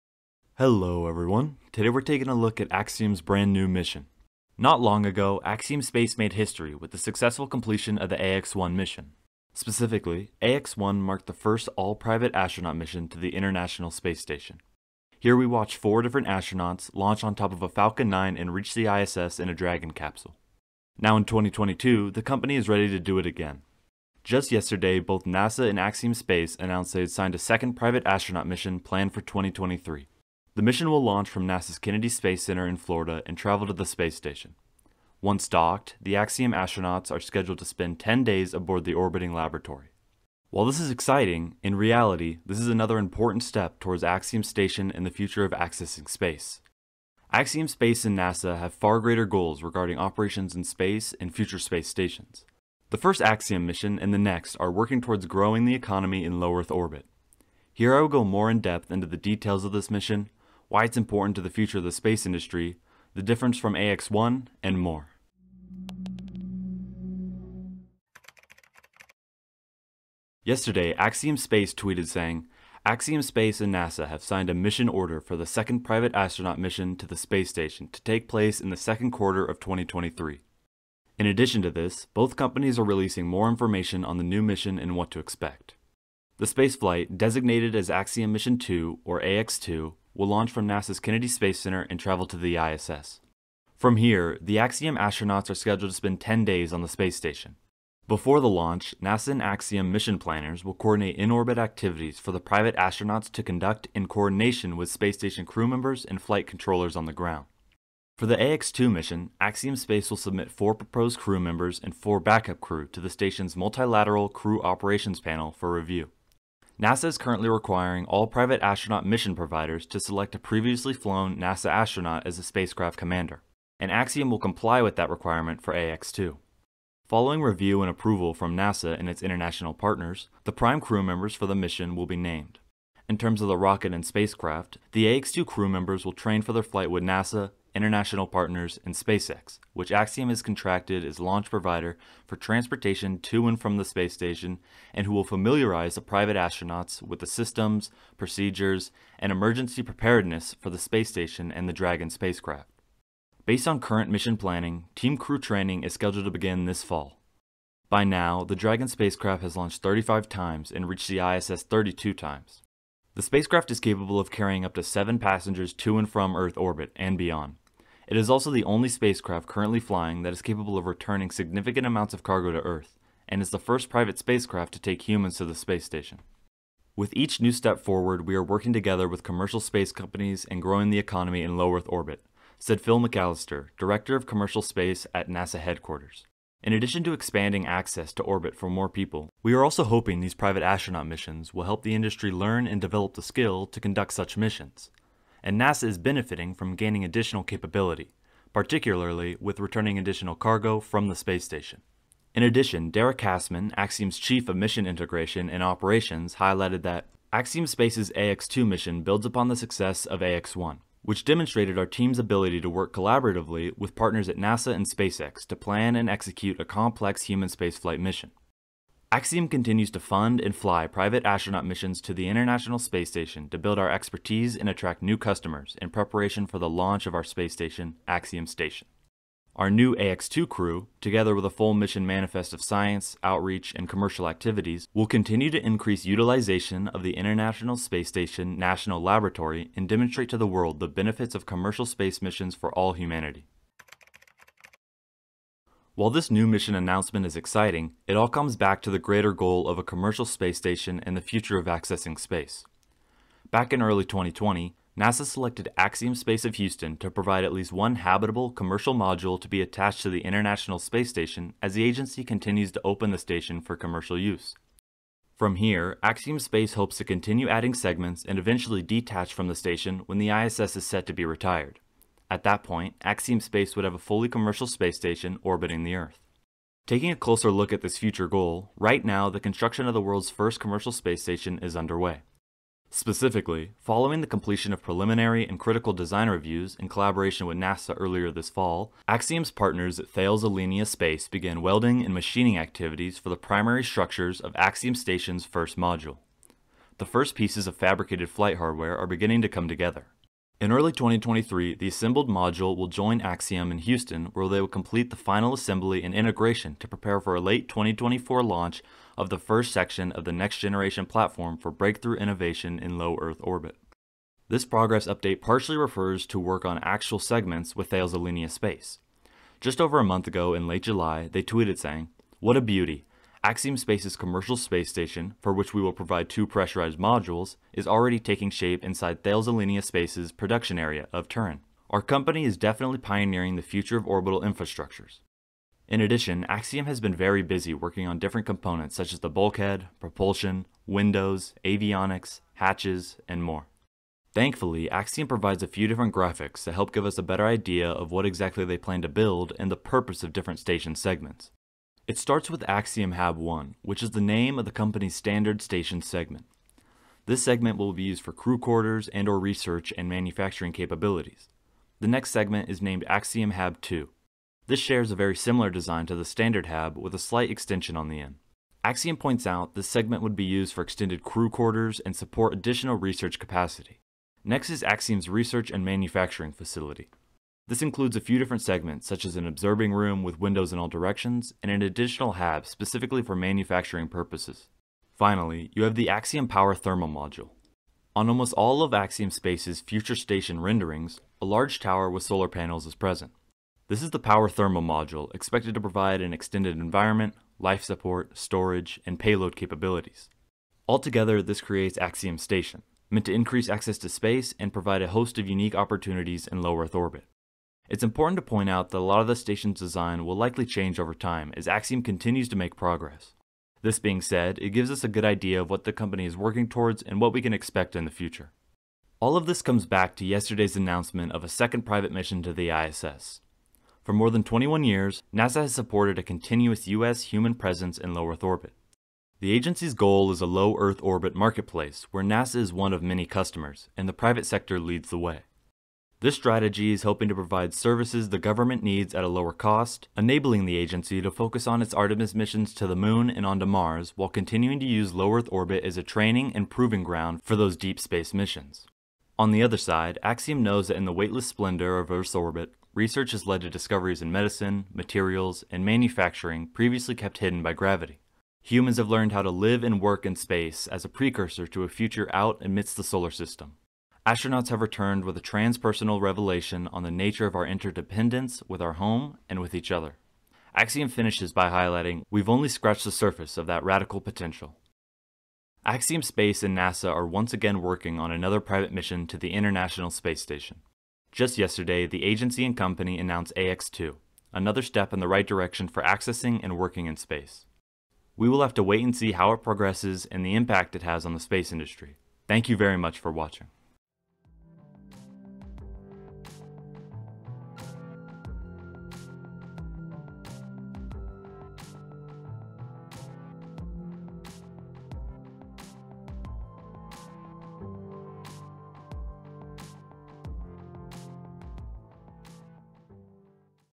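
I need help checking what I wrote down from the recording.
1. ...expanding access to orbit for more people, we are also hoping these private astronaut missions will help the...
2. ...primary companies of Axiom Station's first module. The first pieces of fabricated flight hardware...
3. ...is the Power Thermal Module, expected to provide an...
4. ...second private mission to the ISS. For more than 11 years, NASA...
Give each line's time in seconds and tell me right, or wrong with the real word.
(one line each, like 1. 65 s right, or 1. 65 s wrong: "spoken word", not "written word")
1. 187 s right
2. 293 s wrong: "structures", not "companies"
3. 394 s right
4. 421 s wrong: "21", not "11".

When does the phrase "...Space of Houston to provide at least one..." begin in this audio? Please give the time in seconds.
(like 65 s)
256 s.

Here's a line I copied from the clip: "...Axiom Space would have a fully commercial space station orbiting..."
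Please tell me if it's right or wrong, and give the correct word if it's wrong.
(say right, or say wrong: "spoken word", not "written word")
right.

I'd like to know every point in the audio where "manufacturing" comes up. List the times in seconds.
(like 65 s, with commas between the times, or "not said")
360 s, 375 s, 383 s, 455 s.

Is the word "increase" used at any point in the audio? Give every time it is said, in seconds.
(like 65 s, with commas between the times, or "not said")
235 s, 403 s.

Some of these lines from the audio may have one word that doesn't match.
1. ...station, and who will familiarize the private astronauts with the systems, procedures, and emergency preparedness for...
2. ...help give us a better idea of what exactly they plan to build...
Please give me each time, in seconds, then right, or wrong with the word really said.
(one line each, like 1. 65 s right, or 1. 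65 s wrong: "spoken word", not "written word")
1. 144 s right
2. 346 s right.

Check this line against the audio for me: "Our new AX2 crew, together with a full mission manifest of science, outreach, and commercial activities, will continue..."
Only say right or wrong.
right.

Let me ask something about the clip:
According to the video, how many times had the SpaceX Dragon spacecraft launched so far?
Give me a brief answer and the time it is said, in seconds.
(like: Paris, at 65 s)
35, at 159 s.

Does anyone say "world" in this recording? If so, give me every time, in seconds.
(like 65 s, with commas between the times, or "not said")
240 s, 279 s.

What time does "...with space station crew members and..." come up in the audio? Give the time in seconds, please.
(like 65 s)
104 s.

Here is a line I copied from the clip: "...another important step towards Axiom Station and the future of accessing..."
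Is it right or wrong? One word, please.
right.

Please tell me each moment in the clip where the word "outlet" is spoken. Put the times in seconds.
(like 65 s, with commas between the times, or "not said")
not said.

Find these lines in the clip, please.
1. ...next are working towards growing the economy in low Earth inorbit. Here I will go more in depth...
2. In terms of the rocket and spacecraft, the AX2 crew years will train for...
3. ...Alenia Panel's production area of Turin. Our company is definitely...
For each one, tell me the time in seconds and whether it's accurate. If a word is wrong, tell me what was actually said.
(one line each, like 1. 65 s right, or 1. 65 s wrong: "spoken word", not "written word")
1. 54 s wrong: "orbit", not "inorbit"
2. 133 s wrong: "members", not "years"
3. 329 s wrong: "Space", not "Panel".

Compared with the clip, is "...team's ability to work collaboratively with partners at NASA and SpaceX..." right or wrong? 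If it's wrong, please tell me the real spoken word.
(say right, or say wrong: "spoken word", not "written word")
right.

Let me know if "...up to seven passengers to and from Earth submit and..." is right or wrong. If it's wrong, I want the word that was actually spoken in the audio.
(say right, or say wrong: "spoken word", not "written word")
wrong: "orbit", not "submit".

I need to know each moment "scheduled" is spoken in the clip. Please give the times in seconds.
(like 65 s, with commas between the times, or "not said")
37 s, 95 s, 155 s.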